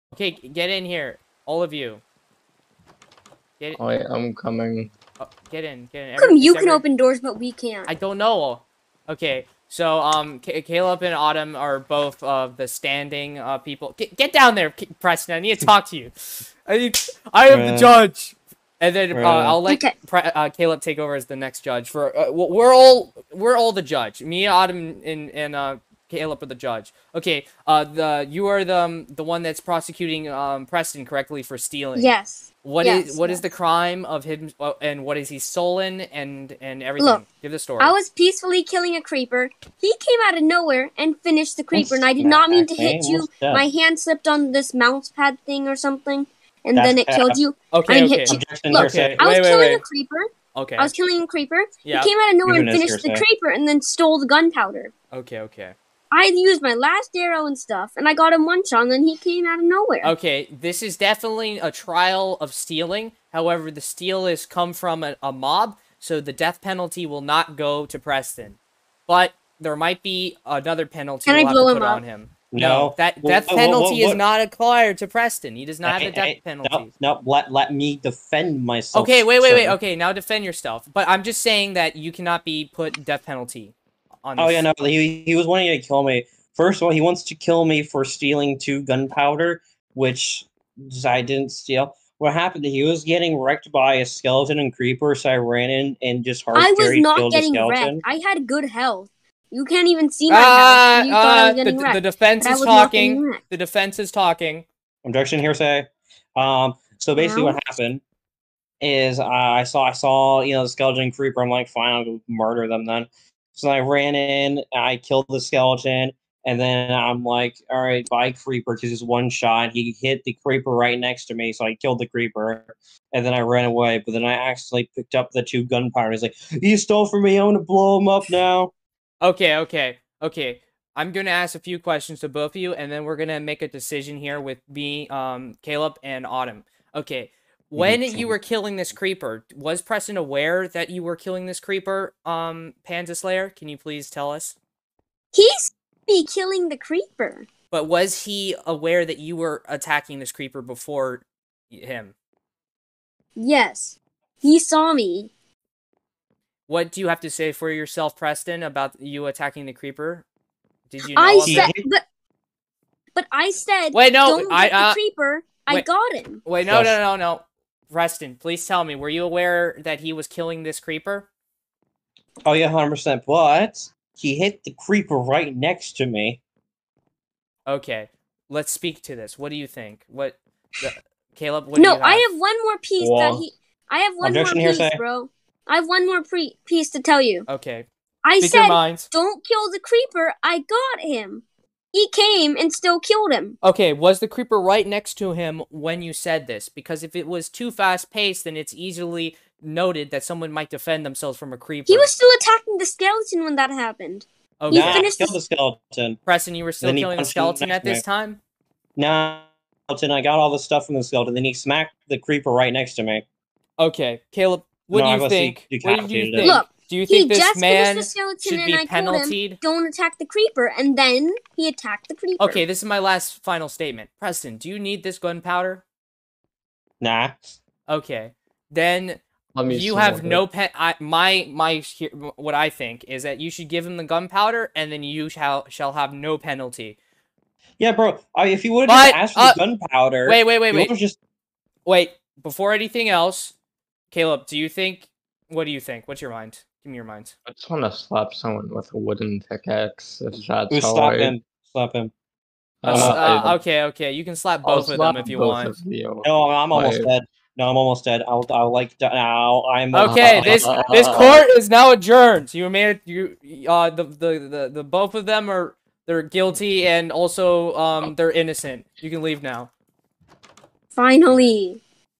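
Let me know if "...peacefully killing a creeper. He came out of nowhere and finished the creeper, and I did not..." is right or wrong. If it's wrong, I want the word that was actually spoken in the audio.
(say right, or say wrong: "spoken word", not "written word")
right.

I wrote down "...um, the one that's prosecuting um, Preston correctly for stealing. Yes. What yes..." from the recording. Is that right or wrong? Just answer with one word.
right.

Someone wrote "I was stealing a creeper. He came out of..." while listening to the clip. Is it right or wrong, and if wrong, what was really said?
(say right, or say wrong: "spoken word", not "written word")
wrong: "killing", not "stealing".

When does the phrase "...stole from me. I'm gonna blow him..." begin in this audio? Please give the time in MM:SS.
02:06.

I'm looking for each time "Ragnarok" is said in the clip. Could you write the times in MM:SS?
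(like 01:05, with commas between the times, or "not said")
not said.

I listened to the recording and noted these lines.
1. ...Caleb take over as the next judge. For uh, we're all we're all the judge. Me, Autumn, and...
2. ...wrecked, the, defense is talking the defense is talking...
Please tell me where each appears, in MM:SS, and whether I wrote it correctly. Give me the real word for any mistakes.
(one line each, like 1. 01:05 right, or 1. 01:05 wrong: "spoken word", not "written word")
1. 00:20 right
2. 01:41 right.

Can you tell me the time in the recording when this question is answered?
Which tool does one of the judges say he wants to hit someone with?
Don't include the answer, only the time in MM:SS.
04:08.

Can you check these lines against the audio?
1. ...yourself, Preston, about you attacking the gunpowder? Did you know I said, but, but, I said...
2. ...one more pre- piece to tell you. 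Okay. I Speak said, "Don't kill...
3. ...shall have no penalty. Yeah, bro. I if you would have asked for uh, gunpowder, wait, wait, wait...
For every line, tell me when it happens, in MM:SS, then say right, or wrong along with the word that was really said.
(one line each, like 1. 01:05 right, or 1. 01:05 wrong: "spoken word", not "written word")
1. 02:37 wrong: "creeper", not "gunpowder"
2. 03:05 right
3. 03:55 right.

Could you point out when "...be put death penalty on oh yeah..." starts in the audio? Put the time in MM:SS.
01:22.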